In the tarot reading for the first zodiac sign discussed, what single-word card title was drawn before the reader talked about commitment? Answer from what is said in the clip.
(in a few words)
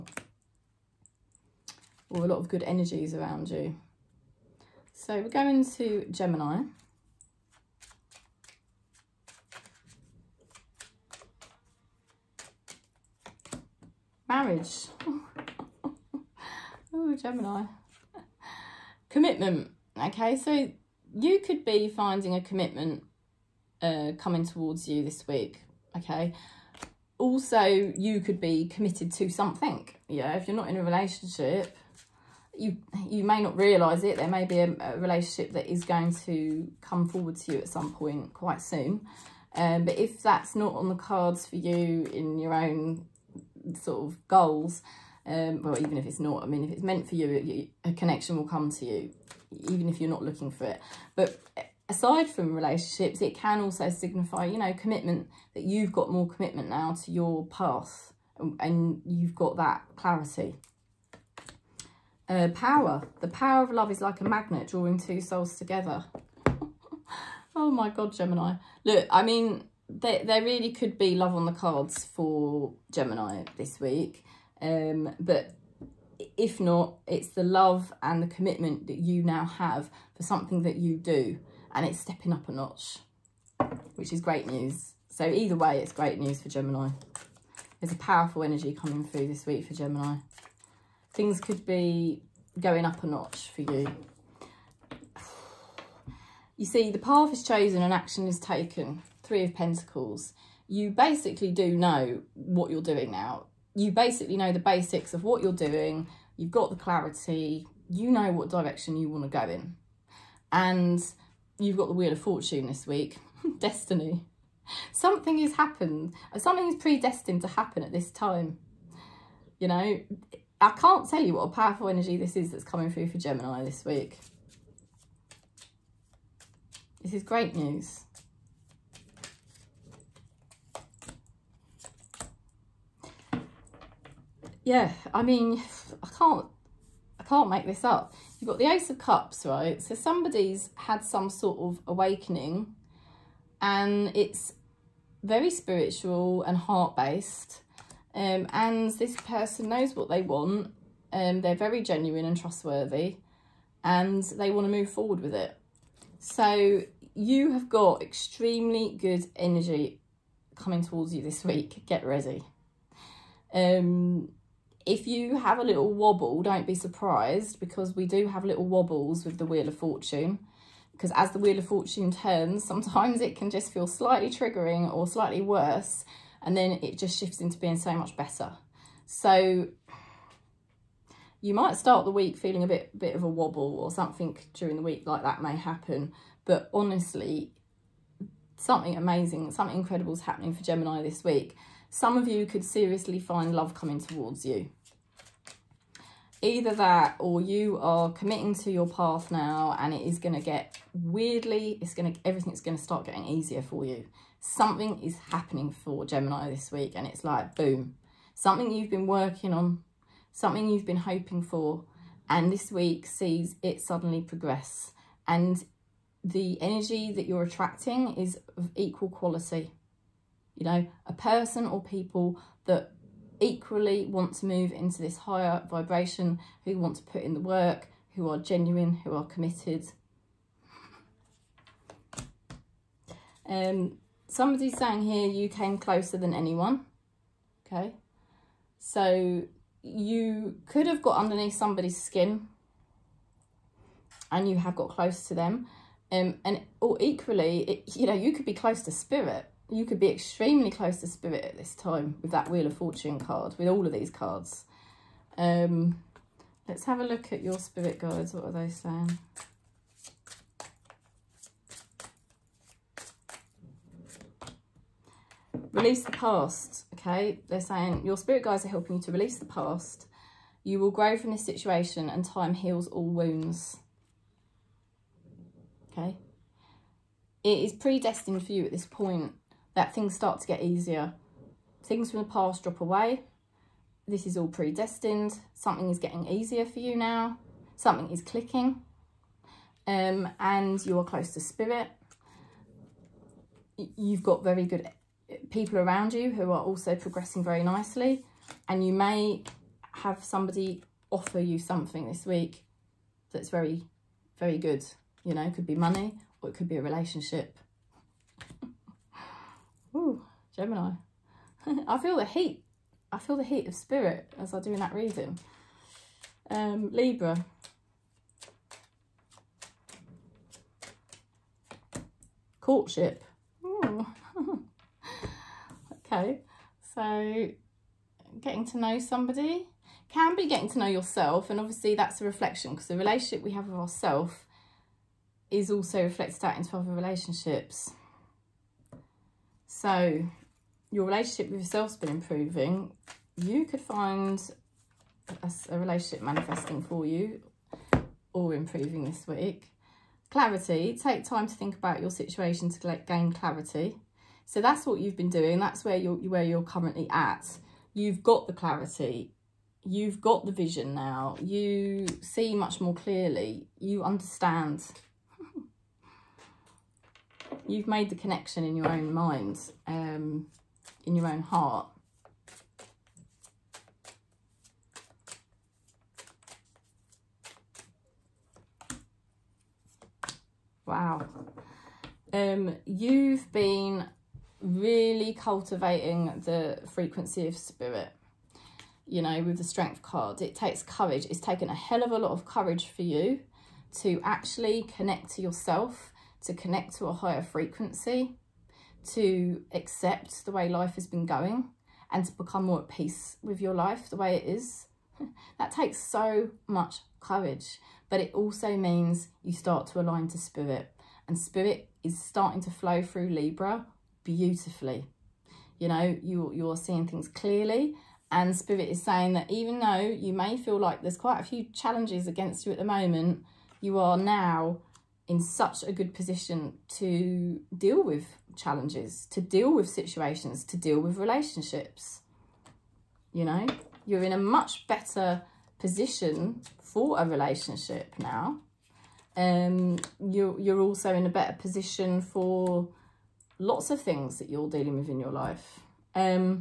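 Marriage.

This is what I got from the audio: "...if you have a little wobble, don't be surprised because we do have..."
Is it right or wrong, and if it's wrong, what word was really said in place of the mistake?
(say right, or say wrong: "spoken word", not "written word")
right.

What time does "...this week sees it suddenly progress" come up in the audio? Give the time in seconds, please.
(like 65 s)
212 s.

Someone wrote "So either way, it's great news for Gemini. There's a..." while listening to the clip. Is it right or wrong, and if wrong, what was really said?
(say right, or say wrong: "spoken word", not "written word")
right.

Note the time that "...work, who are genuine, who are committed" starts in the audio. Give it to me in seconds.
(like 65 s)
227 s.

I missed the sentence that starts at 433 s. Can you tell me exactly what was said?
You know, you're in a much better position for a relationship now.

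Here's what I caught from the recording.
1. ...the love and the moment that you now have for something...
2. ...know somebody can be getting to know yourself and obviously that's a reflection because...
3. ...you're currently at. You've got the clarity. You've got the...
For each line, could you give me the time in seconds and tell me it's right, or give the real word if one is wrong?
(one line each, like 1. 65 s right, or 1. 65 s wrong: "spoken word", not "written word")
1. 77 s wrong: "commitment", not "moment"
2. 328 s right
3. 356 s right.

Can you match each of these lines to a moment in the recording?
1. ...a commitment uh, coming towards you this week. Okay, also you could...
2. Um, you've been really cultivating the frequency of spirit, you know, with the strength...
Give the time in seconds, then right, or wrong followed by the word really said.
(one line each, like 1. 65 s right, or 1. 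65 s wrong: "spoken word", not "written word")
1. 22 s right
2. 382 s right.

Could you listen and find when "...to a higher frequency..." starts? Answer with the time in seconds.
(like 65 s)
396 s.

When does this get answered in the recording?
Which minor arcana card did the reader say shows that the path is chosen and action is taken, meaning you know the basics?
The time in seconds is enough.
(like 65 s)
99 s.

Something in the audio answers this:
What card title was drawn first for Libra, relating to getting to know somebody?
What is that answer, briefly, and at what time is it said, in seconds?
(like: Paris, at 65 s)
Courtship, at 322 s.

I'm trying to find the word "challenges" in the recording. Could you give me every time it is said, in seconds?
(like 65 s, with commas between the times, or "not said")
421 s, 428 s.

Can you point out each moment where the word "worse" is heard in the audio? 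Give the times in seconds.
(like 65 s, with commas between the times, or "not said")
175 s.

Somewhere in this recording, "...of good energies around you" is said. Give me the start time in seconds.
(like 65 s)
2 s.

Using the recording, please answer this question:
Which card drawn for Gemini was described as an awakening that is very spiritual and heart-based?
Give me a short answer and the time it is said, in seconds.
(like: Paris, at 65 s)
Ace of Cups, at 138 s.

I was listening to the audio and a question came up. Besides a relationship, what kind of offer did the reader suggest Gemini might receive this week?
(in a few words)
Money.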